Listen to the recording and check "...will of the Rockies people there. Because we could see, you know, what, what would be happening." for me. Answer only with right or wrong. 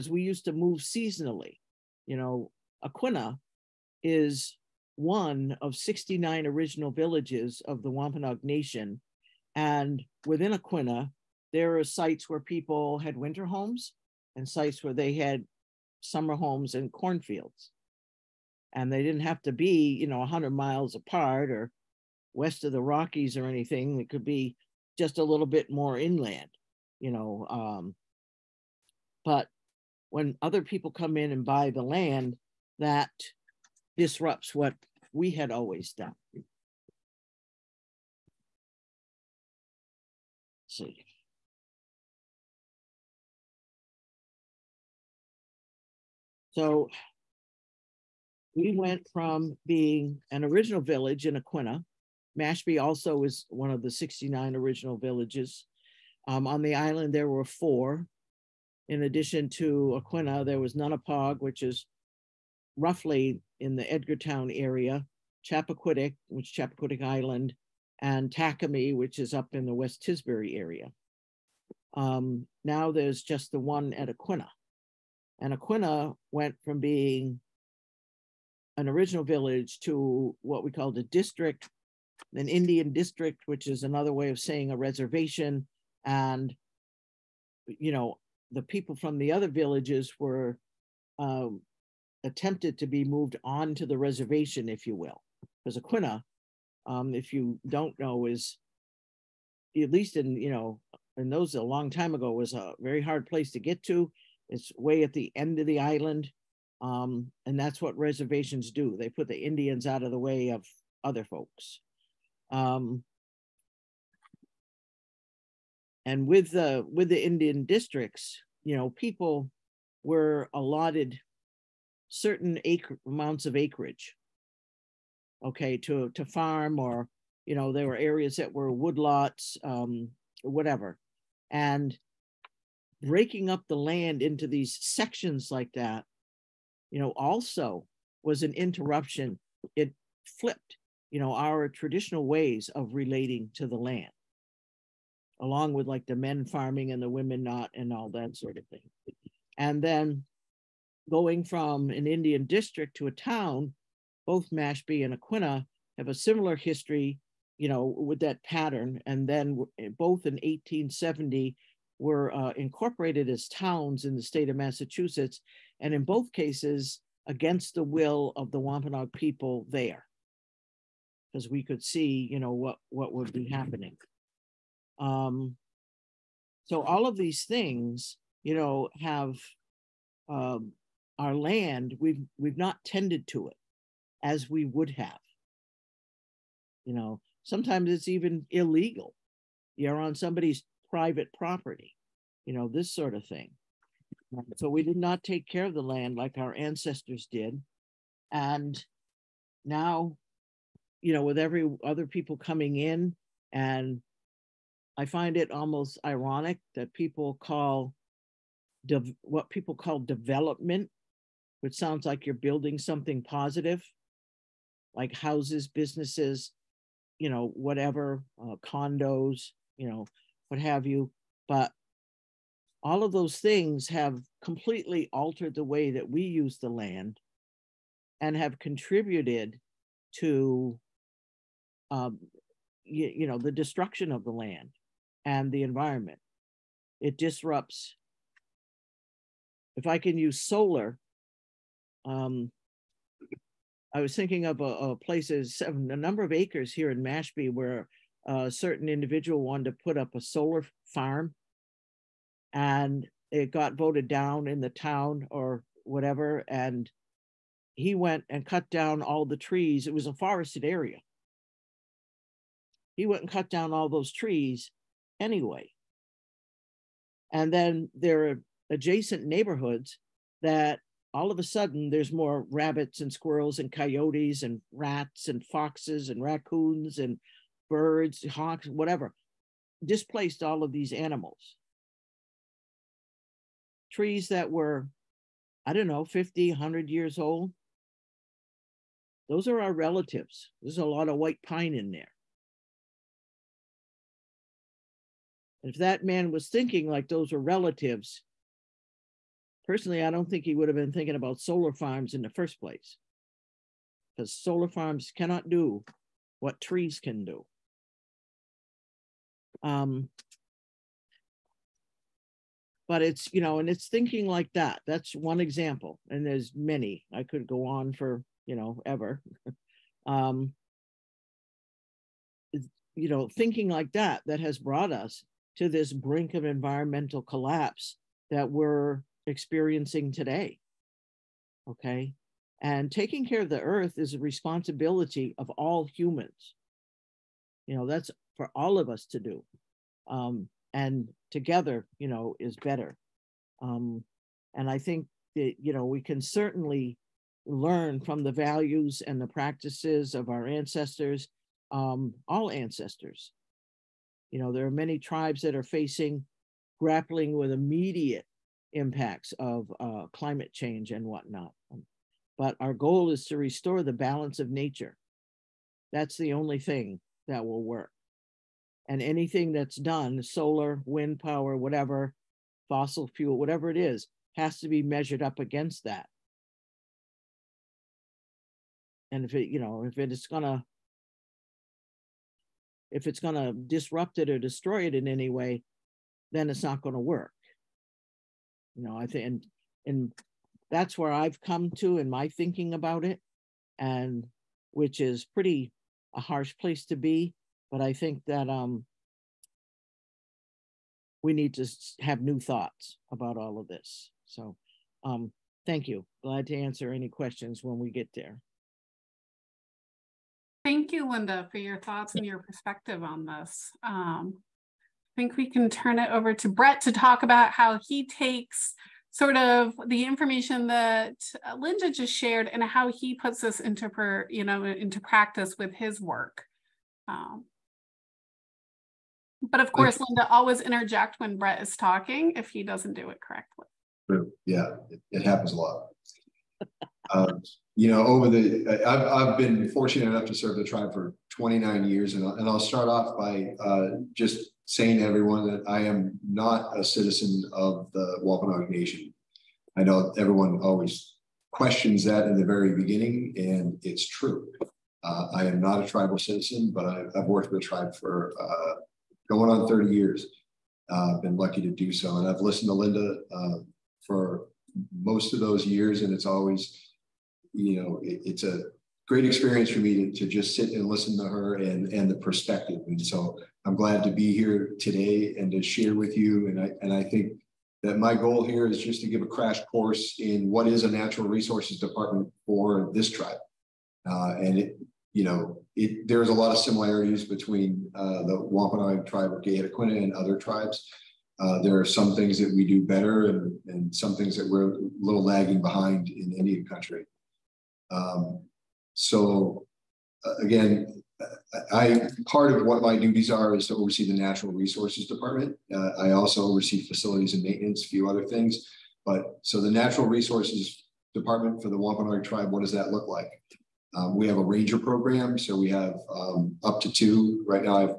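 wrong.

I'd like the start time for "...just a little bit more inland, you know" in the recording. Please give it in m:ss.
0:24.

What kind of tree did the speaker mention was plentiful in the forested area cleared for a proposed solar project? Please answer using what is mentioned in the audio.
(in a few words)
White pine.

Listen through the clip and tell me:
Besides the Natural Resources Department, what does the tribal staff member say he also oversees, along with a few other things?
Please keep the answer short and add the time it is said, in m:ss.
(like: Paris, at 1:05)
Facilities and maintenance, at 8:26.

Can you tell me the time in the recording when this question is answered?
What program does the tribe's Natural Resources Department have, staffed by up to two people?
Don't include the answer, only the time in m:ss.
8:34.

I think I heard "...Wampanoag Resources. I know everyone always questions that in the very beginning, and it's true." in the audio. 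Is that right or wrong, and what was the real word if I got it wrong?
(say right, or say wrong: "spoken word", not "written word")
wrong: "Nation", not "Resources".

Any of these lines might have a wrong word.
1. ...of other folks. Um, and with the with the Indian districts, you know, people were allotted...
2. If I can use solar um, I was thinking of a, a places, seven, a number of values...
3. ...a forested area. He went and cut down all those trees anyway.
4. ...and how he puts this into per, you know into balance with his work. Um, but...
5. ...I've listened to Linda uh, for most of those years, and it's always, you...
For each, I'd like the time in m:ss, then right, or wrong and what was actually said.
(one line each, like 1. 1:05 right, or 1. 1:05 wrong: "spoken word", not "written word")
1. 1:50 right
2. 3:59 wrong: "acres", not "values"
3. 4:20 right
4. 7:02 wrong: "practice", not "balance"
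5. 7:42 right.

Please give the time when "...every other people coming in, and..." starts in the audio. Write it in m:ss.
3:21.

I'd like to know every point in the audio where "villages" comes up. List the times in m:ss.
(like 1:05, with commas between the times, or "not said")
0:06, 0:50, 0:54, 1:19, 1:29.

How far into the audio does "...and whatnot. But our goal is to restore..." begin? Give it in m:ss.
6:00.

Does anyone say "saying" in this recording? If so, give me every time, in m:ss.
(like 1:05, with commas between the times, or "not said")
1:24, 7:24.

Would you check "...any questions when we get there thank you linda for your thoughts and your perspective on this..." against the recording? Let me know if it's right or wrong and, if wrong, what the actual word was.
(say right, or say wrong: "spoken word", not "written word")
right.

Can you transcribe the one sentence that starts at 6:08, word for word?
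And anything that's done, solar, wind power, whatever, fossil fuel, whatever it is, has to be measured up against that.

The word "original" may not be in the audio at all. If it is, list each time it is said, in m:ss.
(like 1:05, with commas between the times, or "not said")
0:06, 0:50, 0:54, 1:18.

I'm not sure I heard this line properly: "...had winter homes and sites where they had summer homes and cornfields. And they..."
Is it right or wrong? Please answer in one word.
right.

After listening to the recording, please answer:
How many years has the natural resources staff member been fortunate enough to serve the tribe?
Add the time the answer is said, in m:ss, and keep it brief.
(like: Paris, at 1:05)
29, at 7:21.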